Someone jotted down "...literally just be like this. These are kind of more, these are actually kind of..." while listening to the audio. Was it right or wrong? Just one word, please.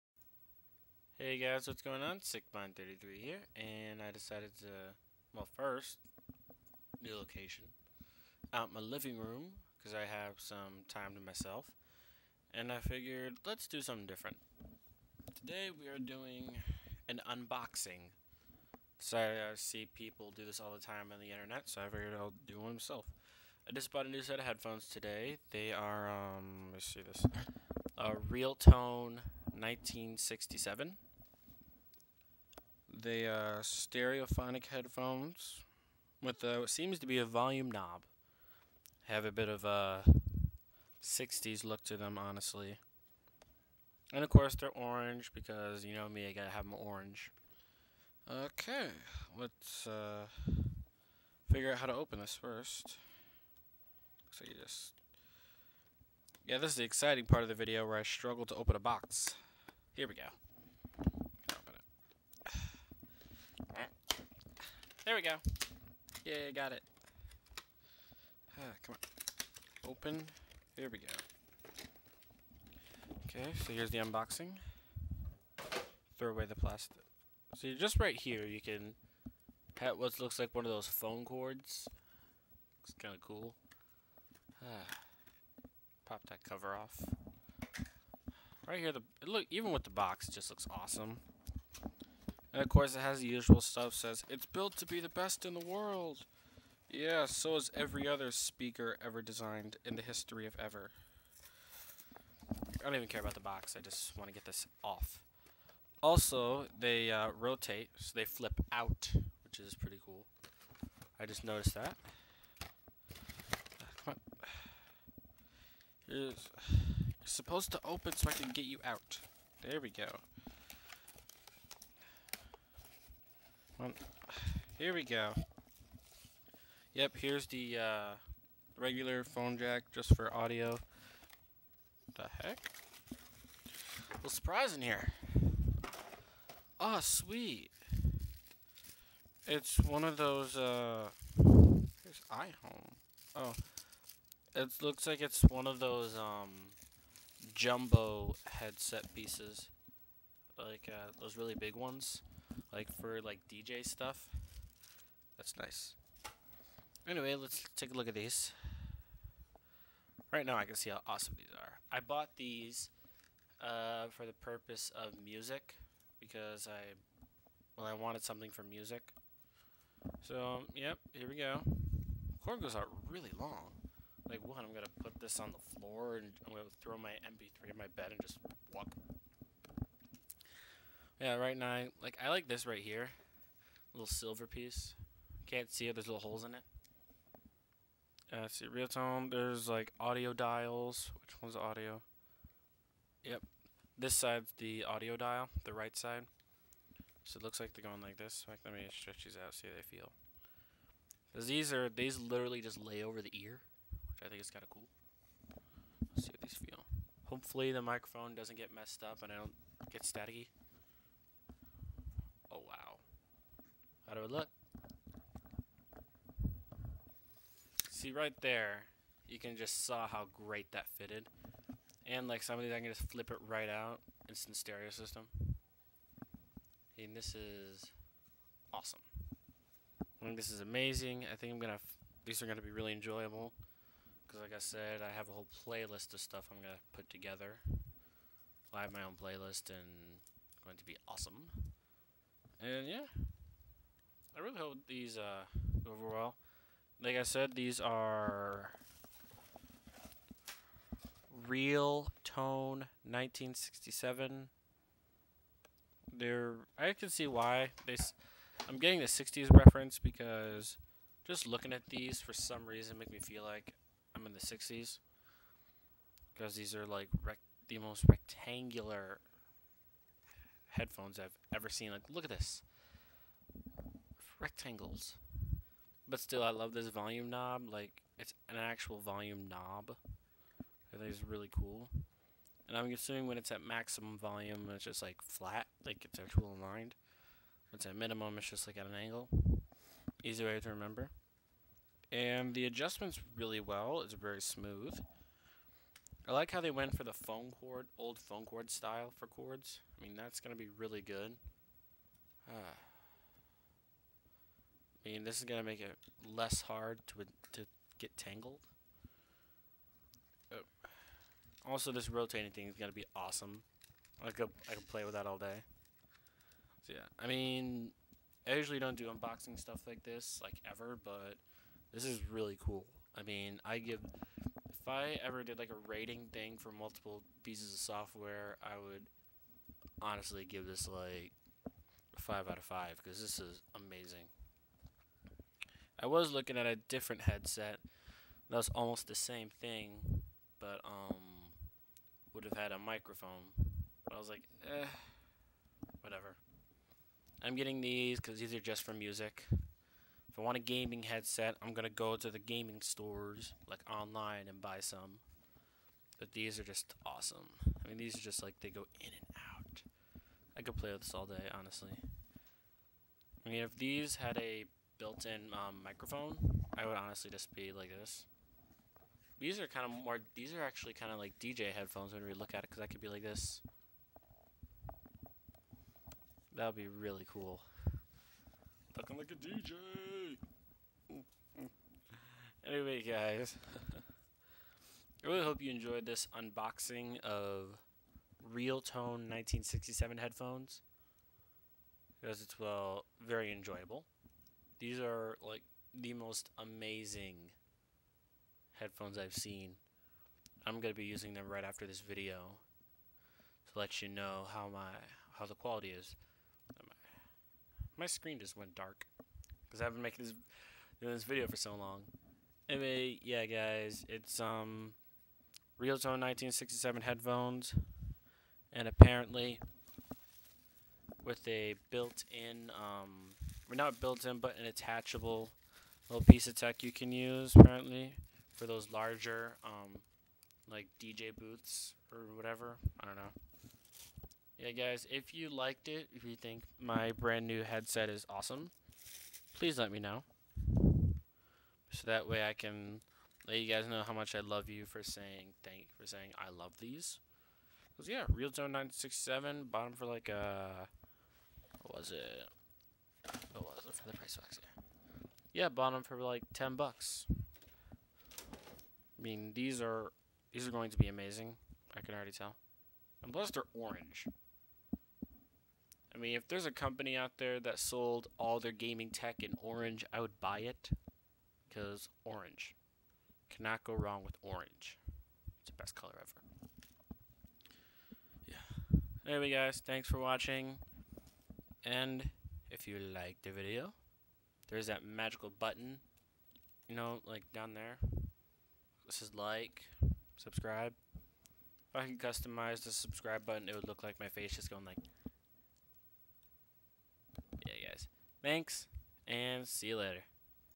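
wrong.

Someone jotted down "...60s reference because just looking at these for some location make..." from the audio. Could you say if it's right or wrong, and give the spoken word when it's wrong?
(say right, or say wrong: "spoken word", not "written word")
wrong: "reason", not "location".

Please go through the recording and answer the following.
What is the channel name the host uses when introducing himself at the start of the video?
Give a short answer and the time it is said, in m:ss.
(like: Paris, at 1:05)
Sickmind 33, at 0:02.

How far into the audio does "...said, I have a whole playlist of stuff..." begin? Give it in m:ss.
3:54.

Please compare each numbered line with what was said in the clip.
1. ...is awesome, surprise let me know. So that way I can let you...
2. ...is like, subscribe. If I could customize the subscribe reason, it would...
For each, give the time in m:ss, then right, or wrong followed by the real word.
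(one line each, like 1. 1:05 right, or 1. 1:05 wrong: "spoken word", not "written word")
1. 7:18 wrong: "please", not "surprise"
2. 8:09 wrong: "button", not "reason".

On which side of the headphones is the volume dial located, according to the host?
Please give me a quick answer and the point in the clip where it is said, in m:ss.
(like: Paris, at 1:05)
Right side, at 3:15.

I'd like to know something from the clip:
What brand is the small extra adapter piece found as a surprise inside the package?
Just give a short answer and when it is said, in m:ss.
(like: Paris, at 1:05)
iHome, at 2:22.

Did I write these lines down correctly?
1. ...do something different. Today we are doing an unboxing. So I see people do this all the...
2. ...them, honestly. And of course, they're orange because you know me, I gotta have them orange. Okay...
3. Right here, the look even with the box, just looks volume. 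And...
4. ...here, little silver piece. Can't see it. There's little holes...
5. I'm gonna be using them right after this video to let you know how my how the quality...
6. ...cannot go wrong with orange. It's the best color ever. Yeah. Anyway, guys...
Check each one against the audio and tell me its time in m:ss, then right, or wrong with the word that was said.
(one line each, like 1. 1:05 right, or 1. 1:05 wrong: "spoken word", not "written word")
1. 0:13 right
2. 0:41 right
3. 1:28 wrong: "awesome", not "volume"
4. 3:02 right
5. 6:40 right
6. 7:53 right.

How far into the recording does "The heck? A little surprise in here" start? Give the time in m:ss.
2:12.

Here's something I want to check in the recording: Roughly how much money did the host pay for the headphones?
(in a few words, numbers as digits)
$10.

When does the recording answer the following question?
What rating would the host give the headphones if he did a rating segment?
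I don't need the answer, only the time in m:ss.
5:32.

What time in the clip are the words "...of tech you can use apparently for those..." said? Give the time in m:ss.
7:06.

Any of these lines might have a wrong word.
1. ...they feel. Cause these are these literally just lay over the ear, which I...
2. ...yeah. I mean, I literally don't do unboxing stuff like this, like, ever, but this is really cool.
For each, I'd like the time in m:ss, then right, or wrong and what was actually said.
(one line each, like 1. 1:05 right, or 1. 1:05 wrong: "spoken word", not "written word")
1. 3:19 right
2. 5:16 wrong: "usually", not "literally".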